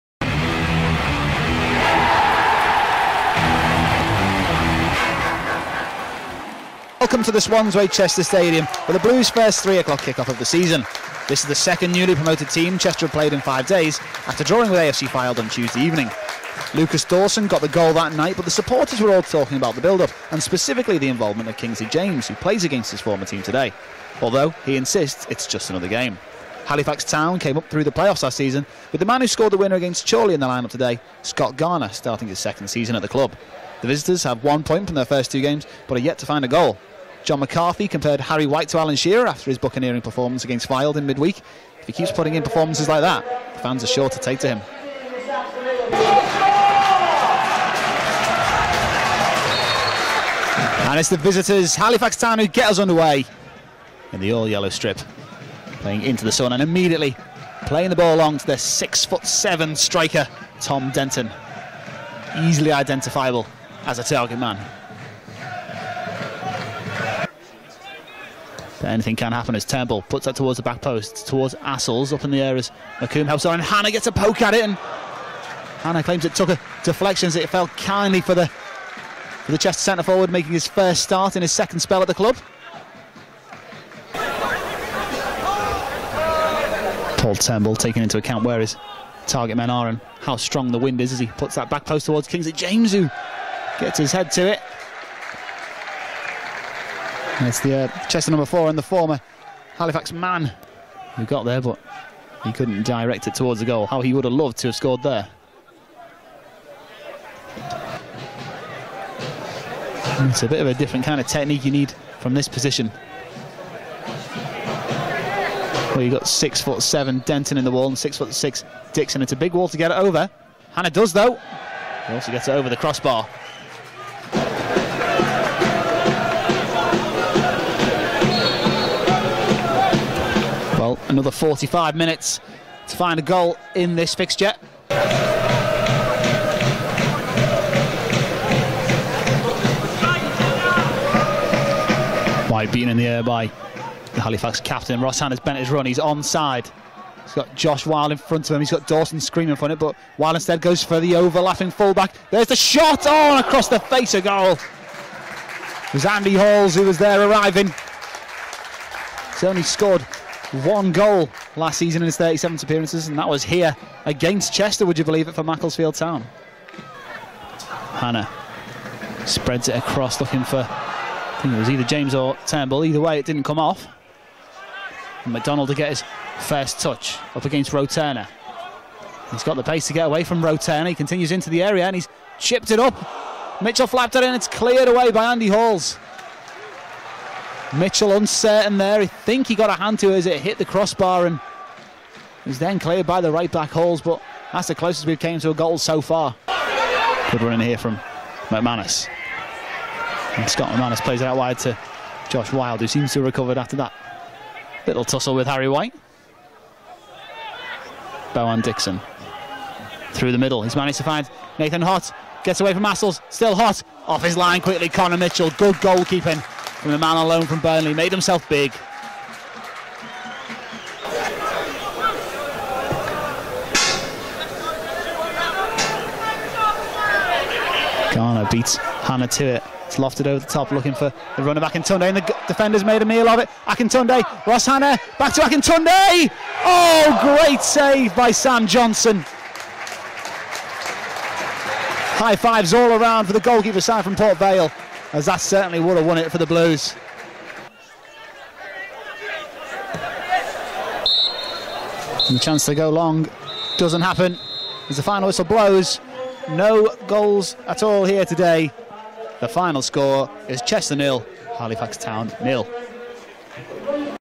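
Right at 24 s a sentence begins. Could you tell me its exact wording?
Although he insists it's just another game.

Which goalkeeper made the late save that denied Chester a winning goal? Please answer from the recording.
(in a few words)
Sam Johnson.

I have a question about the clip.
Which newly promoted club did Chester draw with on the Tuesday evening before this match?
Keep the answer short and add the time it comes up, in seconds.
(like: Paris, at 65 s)
AFC Fylde, at 14 s.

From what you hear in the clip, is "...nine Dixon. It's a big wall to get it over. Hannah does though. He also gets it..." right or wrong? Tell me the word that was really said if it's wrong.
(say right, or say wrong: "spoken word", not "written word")
wrong: "six", not "nine".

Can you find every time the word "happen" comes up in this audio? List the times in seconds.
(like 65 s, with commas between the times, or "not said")
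69 s, 254 s.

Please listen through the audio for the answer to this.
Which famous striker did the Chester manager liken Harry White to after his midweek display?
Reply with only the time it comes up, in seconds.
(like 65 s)
38 s.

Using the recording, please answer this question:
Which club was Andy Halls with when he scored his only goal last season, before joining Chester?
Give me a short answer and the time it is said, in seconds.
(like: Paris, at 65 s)
Macclesfield Town, at 165 s.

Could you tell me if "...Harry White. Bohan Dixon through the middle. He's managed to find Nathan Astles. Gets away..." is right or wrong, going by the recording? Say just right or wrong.
wrong.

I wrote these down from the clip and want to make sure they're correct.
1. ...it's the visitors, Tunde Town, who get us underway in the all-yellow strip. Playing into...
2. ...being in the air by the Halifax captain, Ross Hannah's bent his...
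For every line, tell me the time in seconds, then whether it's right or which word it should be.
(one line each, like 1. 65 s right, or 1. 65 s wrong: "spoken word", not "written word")
1. 50 s wrong: "Halifax", not "Tunde"
2. 142 s right.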